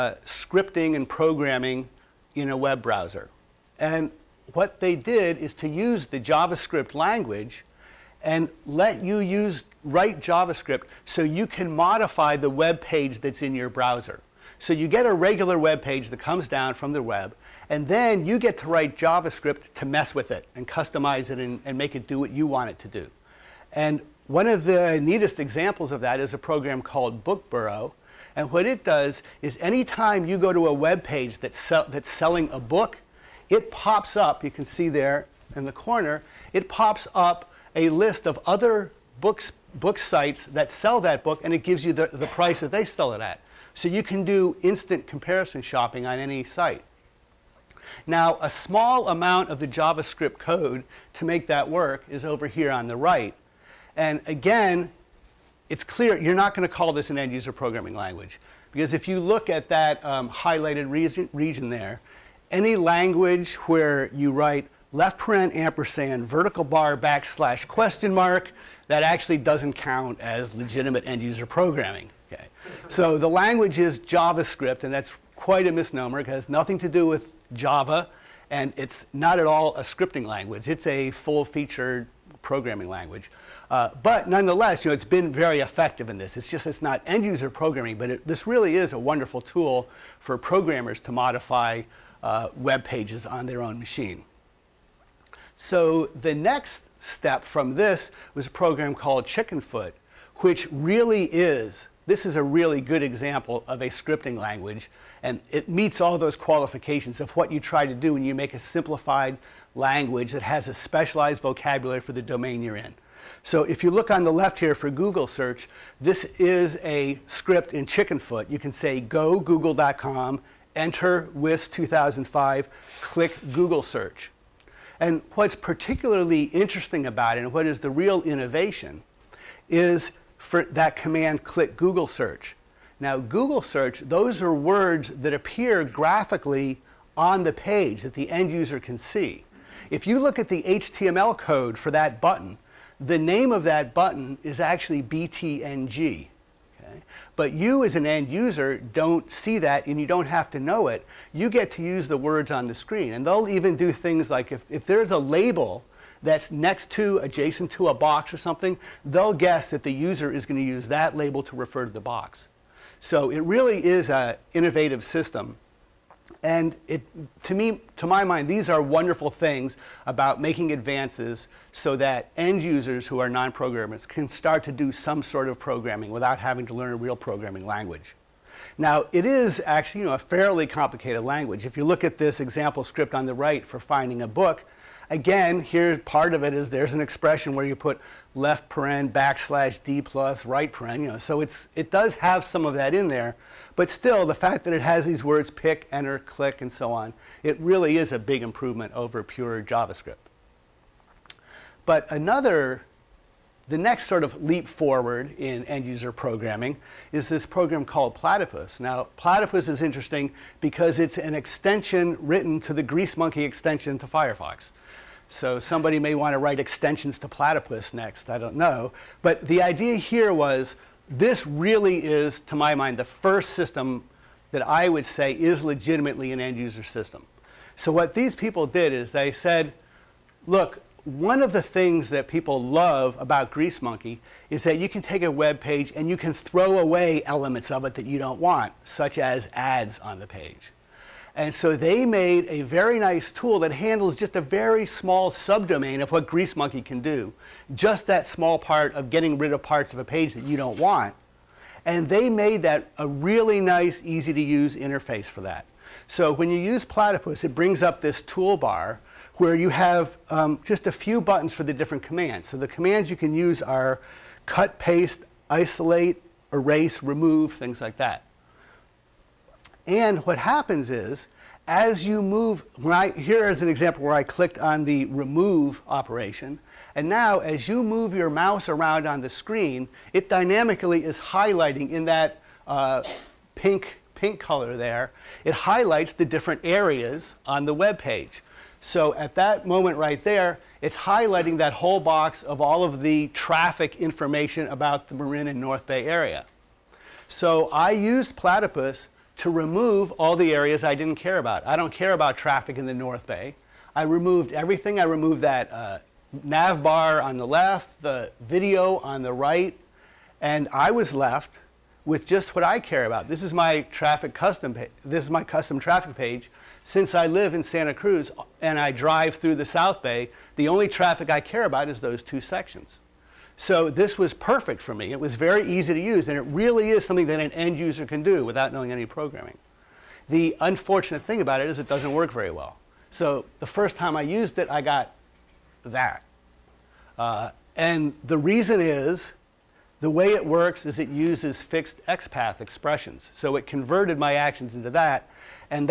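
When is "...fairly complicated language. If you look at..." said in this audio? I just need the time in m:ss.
3:00.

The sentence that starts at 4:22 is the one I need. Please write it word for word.
So the commands you can use are cut, paste, isolate, erase, remove, things like that.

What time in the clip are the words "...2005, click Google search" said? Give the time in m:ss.
2:01.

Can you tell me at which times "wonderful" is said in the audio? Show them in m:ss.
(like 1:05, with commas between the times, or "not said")
1:28, 2:48.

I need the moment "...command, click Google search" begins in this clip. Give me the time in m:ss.
2:10.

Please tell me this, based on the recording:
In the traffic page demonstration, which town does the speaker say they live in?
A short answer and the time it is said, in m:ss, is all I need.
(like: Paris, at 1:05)
Santa Cruz, at 5:17.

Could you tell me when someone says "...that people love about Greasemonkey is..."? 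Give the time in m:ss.
3:52.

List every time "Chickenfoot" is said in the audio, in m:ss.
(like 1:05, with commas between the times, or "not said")
1:39, 1:57.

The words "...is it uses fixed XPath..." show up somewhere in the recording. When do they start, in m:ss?
5:40.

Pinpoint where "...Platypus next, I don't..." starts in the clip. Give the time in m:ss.
3:37.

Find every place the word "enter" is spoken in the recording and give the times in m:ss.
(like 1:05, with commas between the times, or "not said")
2:00, 3:15.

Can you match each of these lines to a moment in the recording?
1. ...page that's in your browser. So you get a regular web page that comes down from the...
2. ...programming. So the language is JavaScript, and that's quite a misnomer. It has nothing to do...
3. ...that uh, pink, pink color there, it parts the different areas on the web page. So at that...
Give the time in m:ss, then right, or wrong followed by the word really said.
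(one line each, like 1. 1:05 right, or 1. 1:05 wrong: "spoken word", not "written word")
1. 0:12 right
2. 1:11 right
3. 4:42 wrong: "highlights", not "parts".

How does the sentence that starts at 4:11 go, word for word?
And they made that a really nice, easy to use interface for that.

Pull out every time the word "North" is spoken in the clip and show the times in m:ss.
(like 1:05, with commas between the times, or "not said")
4:55, 5:02.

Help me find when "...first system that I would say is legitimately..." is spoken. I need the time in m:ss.
3:43.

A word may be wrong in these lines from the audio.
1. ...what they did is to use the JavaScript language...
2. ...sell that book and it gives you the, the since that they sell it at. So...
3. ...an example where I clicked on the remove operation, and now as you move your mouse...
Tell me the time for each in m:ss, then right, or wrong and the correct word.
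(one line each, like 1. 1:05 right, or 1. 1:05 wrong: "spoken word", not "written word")
1. 0:04 right
2. 0:40 wrong: "price", not "since"
3. 4:33 right.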